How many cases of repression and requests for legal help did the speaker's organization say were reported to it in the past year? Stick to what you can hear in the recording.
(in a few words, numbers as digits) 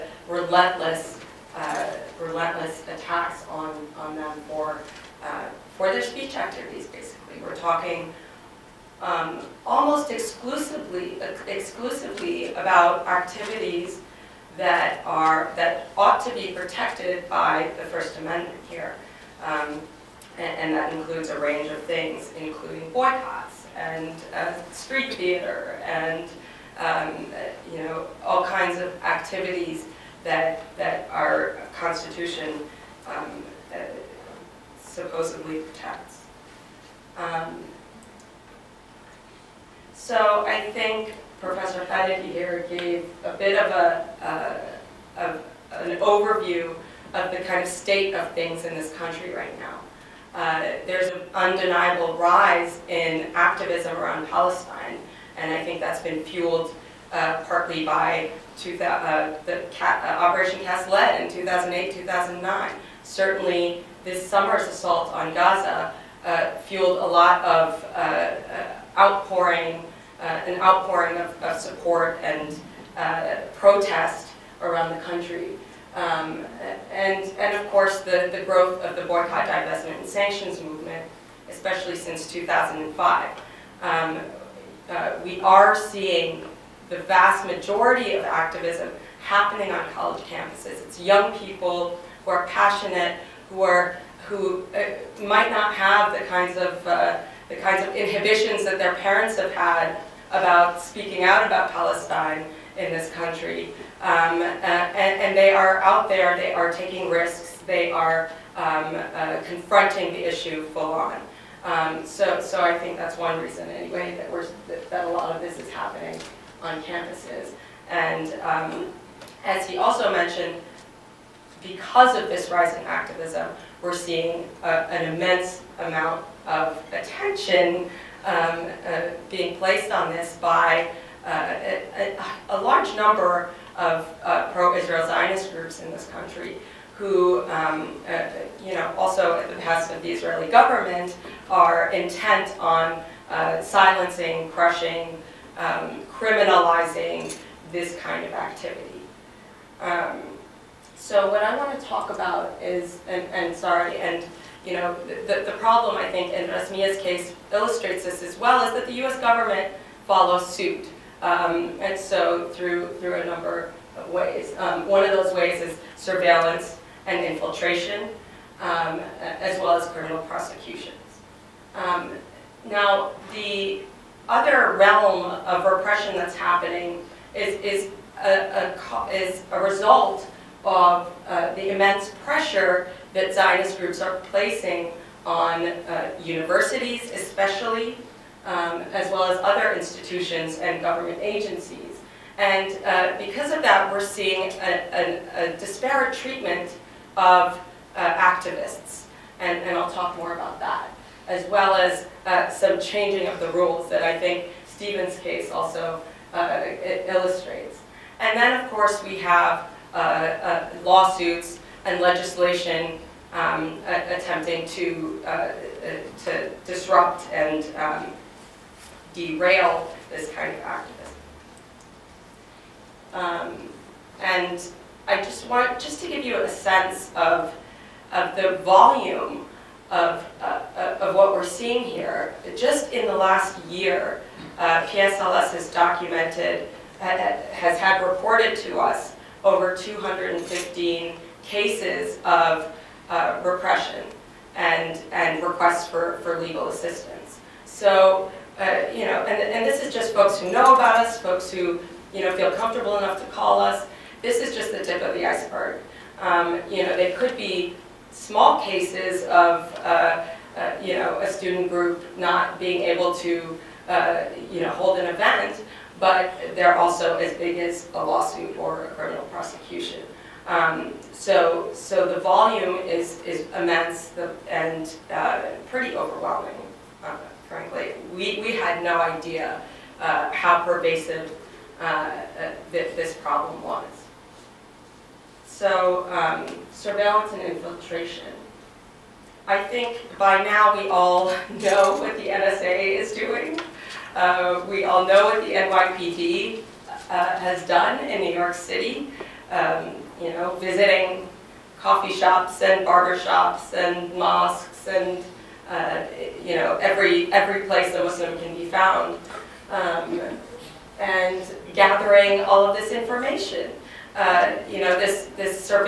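over 215.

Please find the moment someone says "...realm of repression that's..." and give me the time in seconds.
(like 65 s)
174 s.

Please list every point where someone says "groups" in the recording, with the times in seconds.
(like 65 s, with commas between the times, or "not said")
135 s, 183 s, 261 s.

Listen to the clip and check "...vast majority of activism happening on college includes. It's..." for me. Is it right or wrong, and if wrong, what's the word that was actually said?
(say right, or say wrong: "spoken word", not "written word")
wrong: "campuses", not "includes".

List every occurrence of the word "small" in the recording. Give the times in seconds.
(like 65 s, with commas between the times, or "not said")
258 s.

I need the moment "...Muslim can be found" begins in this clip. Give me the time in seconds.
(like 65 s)
308 s.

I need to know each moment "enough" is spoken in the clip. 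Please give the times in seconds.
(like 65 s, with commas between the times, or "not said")
252 s.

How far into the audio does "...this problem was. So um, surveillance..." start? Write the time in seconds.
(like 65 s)
282 s.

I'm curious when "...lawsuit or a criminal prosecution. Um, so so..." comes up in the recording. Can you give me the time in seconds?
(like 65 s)
268 s.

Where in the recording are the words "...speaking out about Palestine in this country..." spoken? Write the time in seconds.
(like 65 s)
100 s.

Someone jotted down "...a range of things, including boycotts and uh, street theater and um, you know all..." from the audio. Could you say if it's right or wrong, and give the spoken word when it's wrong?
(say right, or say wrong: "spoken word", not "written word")
right.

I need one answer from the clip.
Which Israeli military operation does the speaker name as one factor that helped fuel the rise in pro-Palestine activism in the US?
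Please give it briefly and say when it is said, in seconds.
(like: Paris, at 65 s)
Operation Cast Lead, at 60 s.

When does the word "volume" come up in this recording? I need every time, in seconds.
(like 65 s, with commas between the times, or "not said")
228 s, 272 s.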